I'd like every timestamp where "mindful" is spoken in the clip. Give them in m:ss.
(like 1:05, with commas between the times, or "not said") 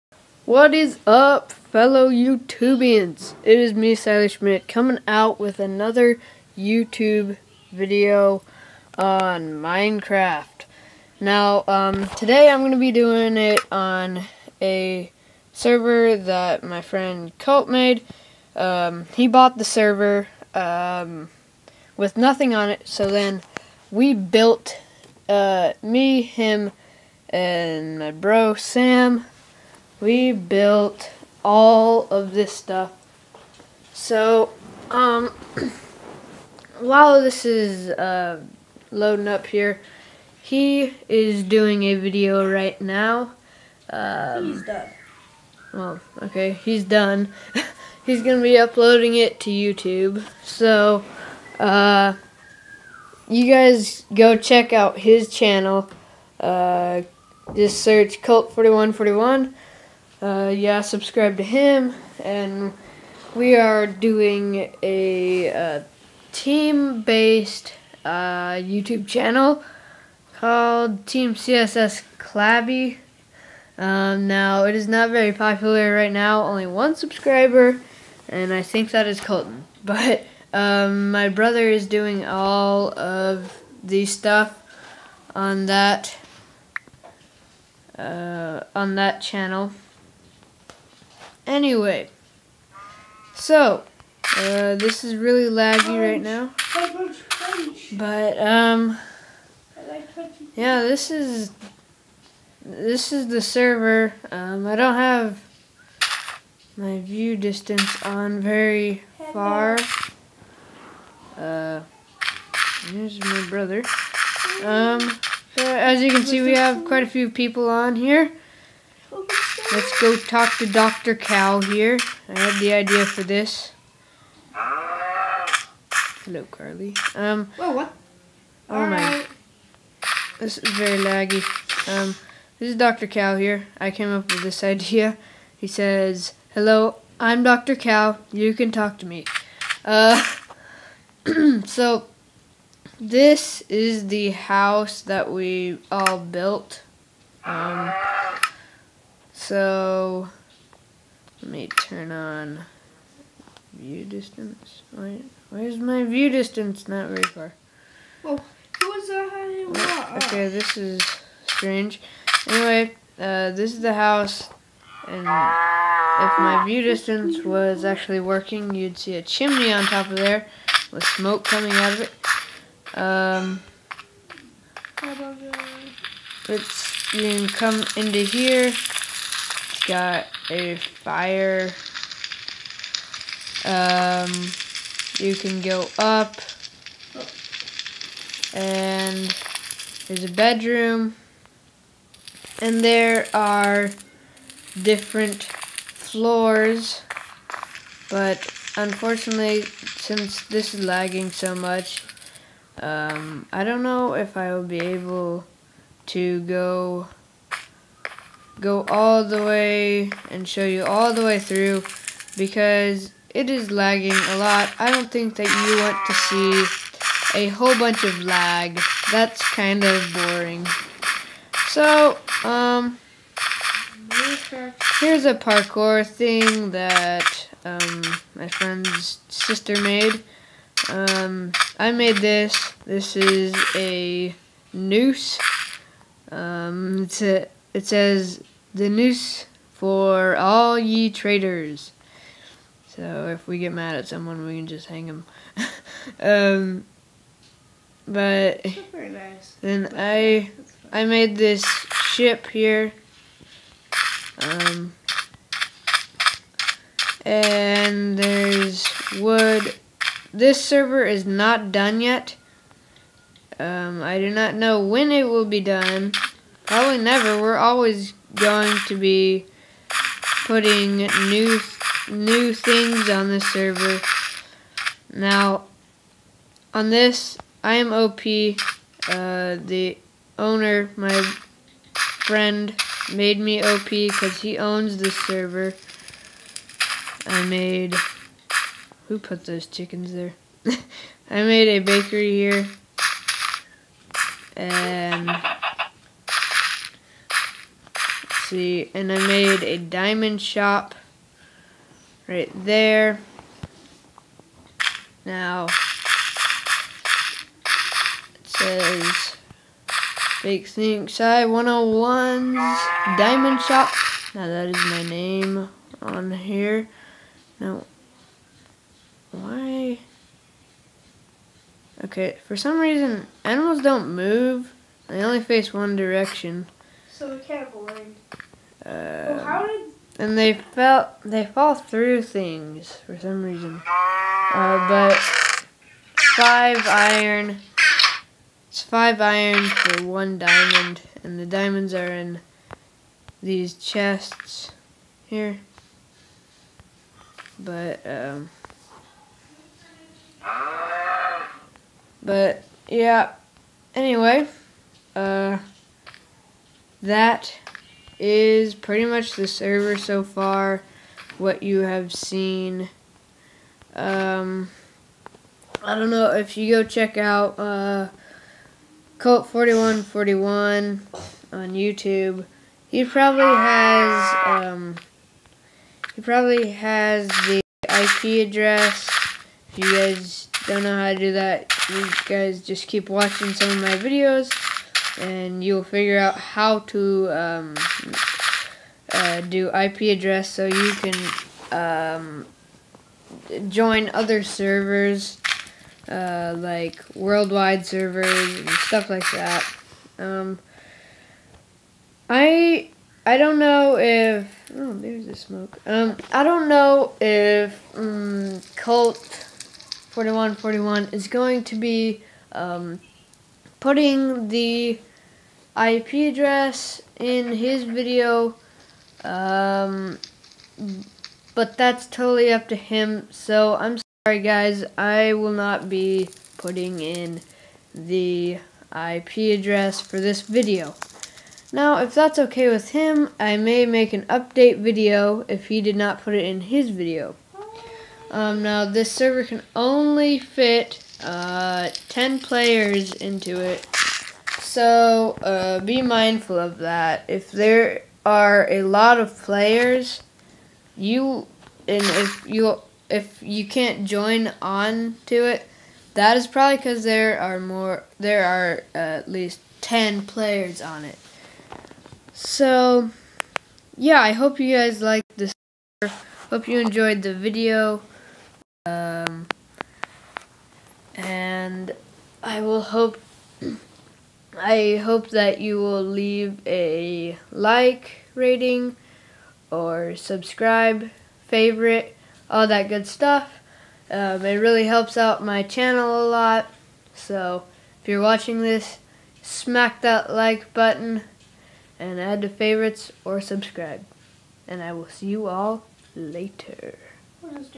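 7:26.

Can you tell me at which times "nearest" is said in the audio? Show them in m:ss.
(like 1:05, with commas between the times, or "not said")
not said.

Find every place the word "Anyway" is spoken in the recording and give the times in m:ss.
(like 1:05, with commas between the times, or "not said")
1:31, 2:42, 5:53.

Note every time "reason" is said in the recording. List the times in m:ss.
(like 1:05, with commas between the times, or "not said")
5:22, 5:33.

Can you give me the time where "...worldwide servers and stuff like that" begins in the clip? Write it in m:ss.
6:37.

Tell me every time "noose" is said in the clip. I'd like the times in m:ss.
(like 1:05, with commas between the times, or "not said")
3:54, 3:58.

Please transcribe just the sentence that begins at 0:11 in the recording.
Now, um, today I'm going to be doing it on a server that my friend Colt made.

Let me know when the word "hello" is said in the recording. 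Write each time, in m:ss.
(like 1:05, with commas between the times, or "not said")
2:04, 2:16.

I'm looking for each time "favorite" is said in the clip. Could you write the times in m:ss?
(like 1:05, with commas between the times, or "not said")
8:01, 8:12.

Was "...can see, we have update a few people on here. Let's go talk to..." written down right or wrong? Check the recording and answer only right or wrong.
wrong.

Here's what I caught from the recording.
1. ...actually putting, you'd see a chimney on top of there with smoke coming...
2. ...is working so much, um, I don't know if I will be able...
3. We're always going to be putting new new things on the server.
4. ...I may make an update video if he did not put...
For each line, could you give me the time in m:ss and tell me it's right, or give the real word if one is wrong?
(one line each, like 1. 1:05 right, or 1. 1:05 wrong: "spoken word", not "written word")
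1. 2:47 wrong: "working", not "putting"
2. 3:20 wrong: "lagging", not "working"
3. 4:27 right
4. 7:13 right.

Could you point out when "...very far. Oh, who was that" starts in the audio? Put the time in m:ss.
2:37.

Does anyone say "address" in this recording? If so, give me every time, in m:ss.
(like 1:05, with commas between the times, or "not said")
6:18, 6:30, 6:56, 7:09.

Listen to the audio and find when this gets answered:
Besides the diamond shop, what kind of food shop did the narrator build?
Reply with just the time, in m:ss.
4:51.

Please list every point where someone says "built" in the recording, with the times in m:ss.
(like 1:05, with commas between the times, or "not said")
0:24, 0:30, 2:26.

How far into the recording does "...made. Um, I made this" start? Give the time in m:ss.
3:49.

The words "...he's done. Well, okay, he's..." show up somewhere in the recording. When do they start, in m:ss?
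0:44.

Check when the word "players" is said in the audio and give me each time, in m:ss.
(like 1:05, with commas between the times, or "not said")
7:22, 7:29, 7:40.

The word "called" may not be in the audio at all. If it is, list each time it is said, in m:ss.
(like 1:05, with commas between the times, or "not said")
1:10.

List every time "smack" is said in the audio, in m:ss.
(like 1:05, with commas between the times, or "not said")
8:09.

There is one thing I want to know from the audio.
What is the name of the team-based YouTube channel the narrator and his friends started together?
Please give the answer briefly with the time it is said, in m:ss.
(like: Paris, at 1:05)
Team CSS Clabby, at 1:11.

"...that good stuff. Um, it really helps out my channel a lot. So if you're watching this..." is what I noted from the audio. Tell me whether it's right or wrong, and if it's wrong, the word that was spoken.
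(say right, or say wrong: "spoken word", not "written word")
right.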